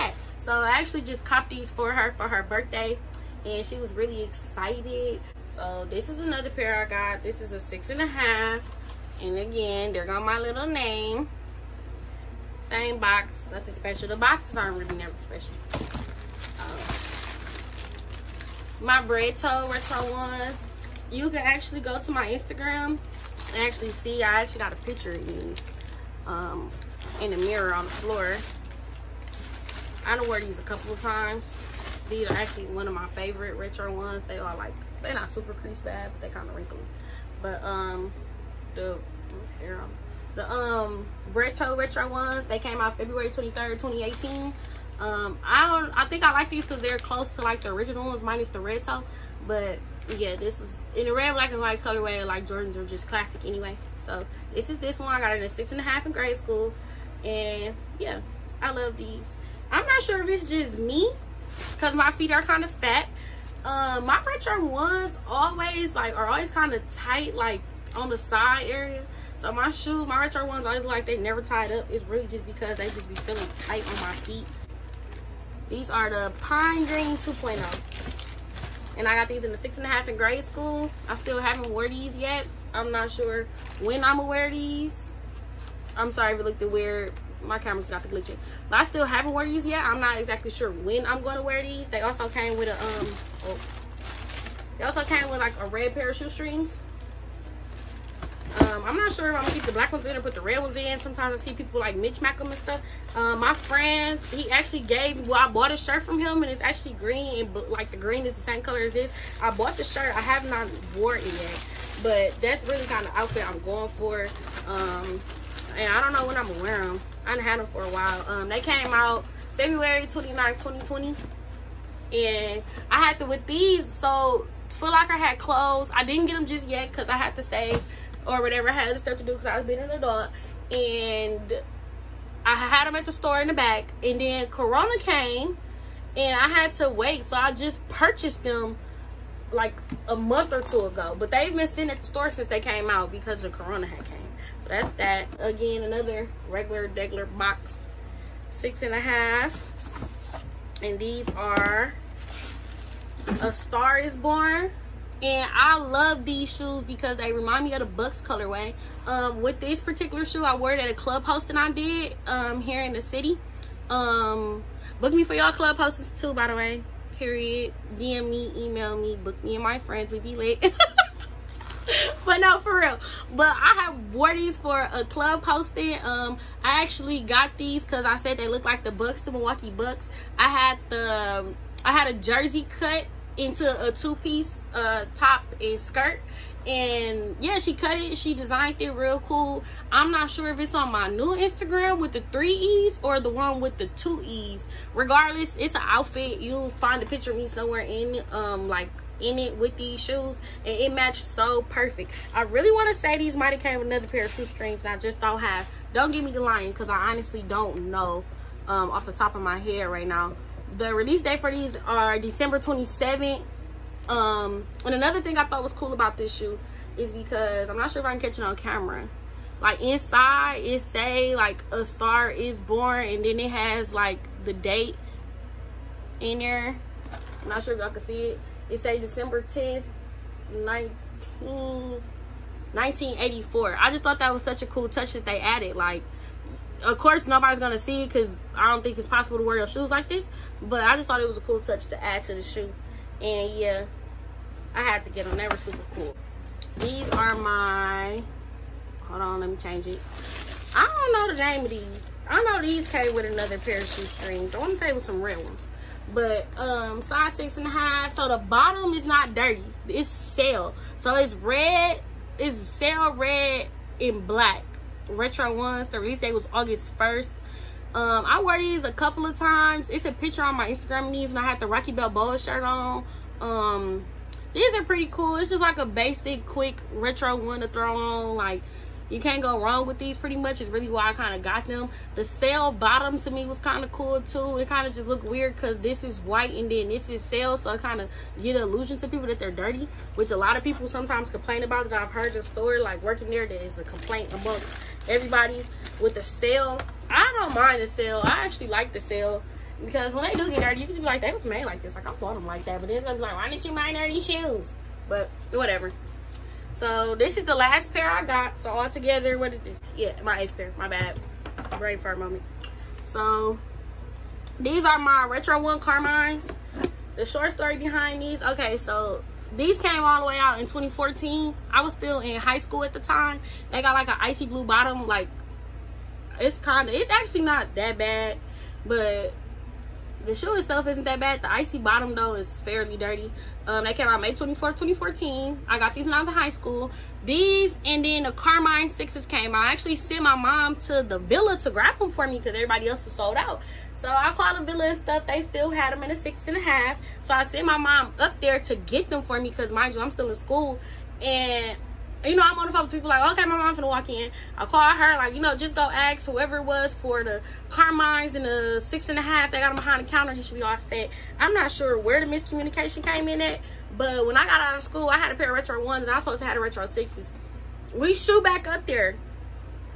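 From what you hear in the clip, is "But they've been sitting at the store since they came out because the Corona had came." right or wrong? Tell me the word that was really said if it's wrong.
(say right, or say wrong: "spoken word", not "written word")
right.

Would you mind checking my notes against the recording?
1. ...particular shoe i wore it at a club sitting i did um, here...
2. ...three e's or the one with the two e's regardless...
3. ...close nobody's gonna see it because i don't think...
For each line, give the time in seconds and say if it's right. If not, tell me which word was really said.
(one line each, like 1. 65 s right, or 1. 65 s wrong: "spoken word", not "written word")
1. 159 s wrong: "hosting", not "sitting"
2. 192 s right
3. 236 s wrong: "course", not "close".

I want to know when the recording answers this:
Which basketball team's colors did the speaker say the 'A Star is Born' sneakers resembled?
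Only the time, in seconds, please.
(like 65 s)
179 s.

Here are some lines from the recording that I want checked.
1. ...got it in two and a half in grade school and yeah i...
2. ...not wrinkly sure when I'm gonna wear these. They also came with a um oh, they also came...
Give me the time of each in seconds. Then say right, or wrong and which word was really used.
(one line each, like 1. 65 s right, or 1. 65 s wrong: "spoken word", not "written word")
1. 55 s wrong: "six", not "two"
2. 89 s wrong: "exactly", not "wrinkly".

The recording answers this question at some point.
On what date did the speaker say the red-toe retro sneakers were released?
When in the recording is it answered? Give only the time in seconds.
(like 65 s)
42 s.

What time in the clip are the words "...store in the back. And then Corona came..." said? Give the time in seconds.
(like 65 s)
133 s.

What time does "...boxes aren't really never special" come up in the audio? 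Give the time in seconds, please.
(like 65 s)
14 s.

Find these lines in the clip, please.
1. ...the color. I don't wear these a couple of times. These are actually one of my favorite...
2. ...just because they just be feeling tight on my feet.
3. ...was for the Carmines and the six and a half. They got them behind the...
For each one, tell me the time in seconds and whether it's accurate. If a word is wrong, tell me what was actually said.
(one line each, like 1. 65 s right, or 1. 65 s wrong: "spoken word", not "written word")
1. 27 s wrong: "floor", not "color"
2. 72 s right
3. 356 s right.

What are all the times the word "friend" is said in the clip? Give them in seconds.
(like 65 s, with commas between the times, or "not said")
103 s, 169 s.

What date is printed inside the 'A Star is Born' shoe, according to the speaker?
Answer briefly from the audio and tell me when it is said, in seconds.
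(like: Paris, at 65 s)
December 10, 1984, at 228 s.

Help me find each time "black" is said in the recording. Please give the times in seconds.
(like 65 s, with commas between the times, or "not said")
51 s, 99 s, 264 s.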